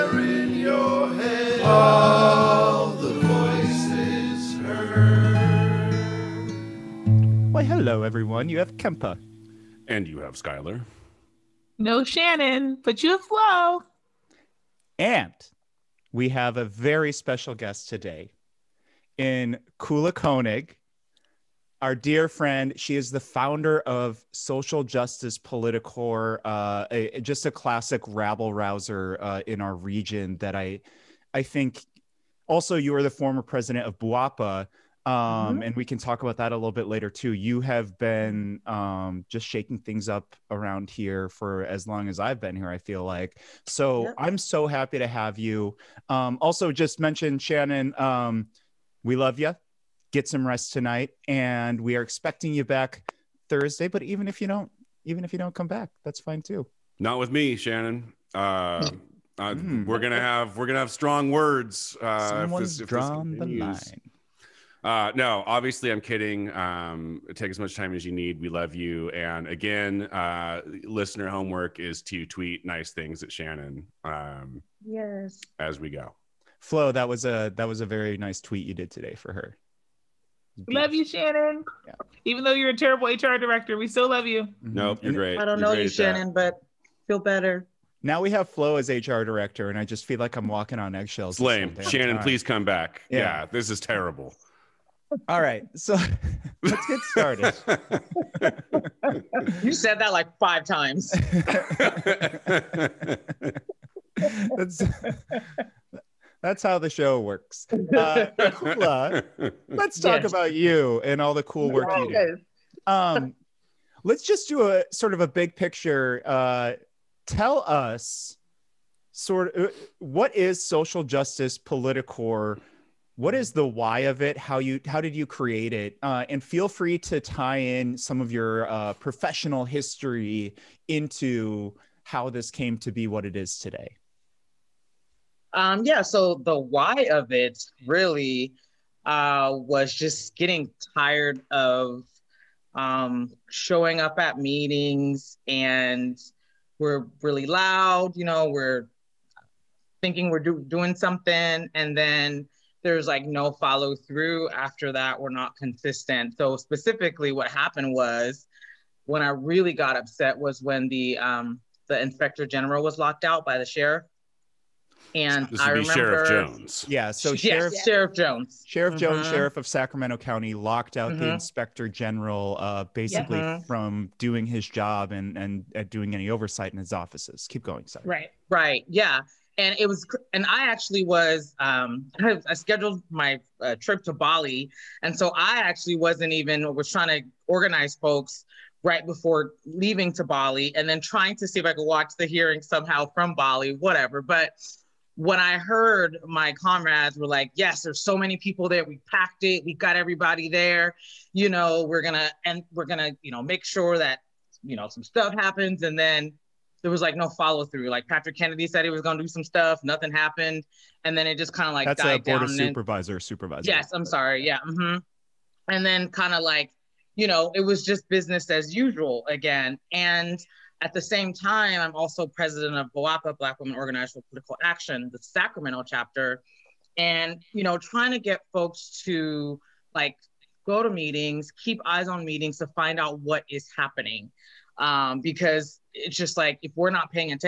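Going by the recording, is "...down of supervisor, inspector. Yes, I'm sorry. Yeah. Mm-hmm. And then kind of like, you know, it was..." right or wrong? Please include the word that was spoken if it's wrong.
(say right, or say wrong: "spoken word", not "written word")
wrong: "supervisor", not "inspector".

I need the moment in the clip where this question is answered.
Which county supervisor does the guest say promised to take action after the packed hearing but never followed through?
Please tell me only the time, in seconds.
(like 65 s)
208 s.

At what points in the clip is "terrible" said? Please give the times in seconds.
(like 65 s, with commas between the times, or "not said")
82 s, 93 s.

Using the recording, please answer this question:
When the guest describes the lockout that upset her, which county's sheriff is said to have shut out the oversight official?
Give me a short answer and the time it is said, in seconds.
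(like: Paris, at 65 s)
Sacramento County, at 169 s.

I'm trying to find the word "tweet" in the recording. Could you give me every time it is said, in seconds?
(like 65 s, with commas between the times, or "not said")
72 s, 78 s.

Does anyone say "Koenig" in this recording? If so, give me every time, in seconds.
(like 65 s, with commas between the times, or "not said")
20 s.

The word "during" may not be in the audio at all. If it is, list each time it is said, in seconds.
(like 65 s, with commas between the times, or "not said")
not said.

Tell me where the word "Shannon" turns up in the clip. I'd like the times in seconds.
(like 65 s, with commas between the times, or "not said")
12 s, 47 s, 57 s, 73 s, 81 s, 85 s, 91 s.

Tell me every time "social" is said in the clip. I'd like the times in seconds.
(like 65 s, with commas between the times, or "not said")
24 s, 120 s.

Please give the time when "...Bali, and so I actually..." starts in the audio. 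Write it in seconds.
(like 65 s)
184 s.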